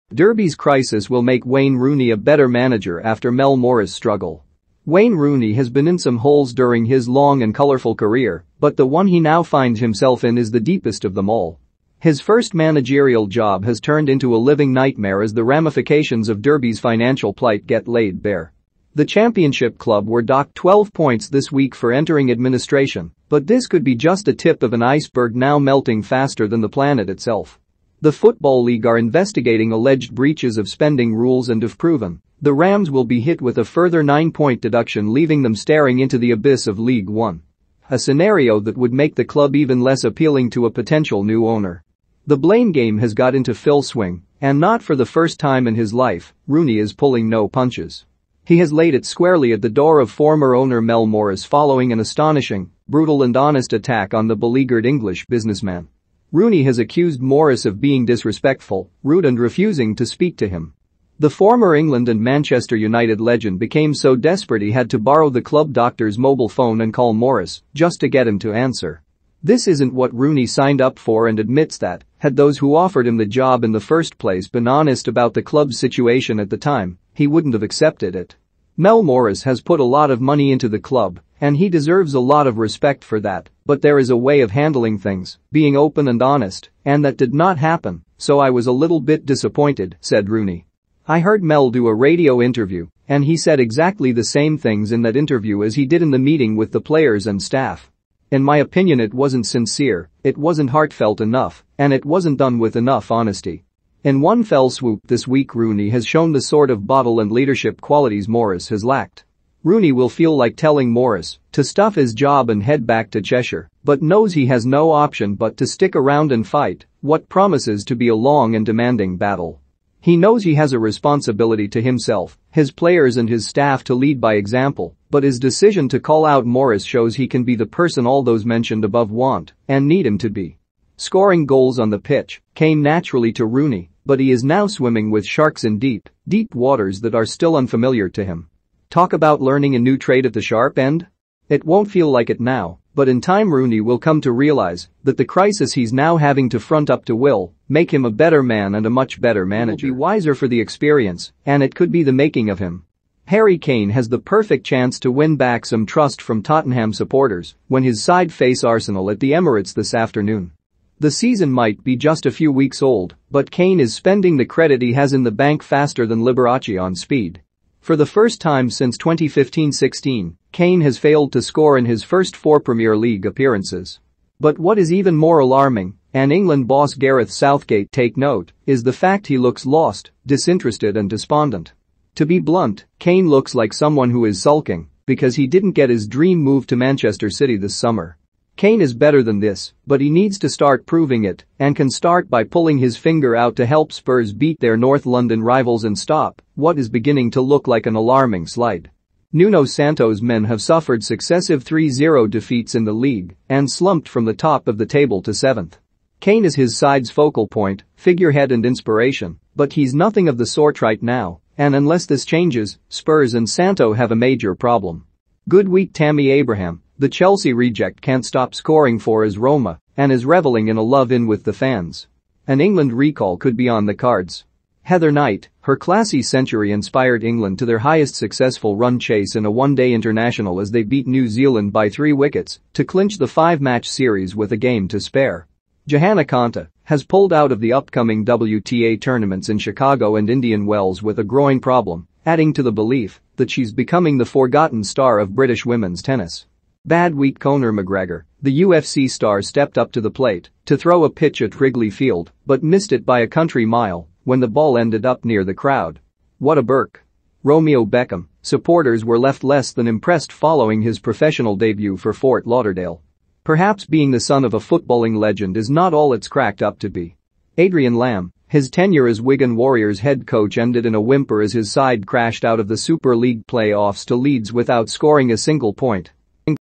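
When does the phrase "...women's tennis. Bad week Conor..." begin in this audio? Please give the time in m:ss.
4:05.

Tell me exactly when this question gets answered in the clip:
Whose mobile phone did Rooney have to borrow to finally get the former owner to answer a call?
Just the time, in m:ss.
1:05.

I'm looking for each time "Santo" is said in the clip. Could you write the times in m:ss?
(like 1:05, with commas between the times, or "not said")
3:19, 3:33.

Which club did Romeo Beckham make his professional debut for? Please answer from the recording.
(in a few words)
Fort Lauderdale.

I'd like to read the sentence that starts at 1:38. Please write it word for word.
In my opinion it wasn't sincere, it wasn't heartfelt enough, and it wasn't done with enough honesty.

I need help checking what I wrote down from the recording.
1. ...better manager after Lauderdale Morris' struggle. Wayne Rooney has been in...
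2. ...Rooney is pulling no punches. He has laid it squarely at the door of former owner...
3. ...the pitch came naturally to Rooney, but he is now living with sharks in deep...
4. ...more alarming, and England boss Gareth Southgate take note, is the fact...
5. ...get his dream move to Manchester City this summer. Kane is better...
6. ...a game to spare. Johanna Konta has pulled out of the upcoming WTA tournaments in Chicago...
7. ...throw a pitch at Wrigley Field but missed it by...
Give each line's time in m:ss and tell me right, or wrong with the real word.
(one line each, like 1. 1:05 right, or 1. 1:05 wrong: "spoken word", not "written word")
1. 0:02 wrong: "Mel", not "Lauderdale"
2. 0:46 right
3. 2:11 wrong: "swimming", not "living"
4. 2:55 right
5. 3:05 right
6. 3:54 right
7. 4:10 right.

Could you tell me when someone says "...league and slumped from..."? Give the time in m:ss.
3:22.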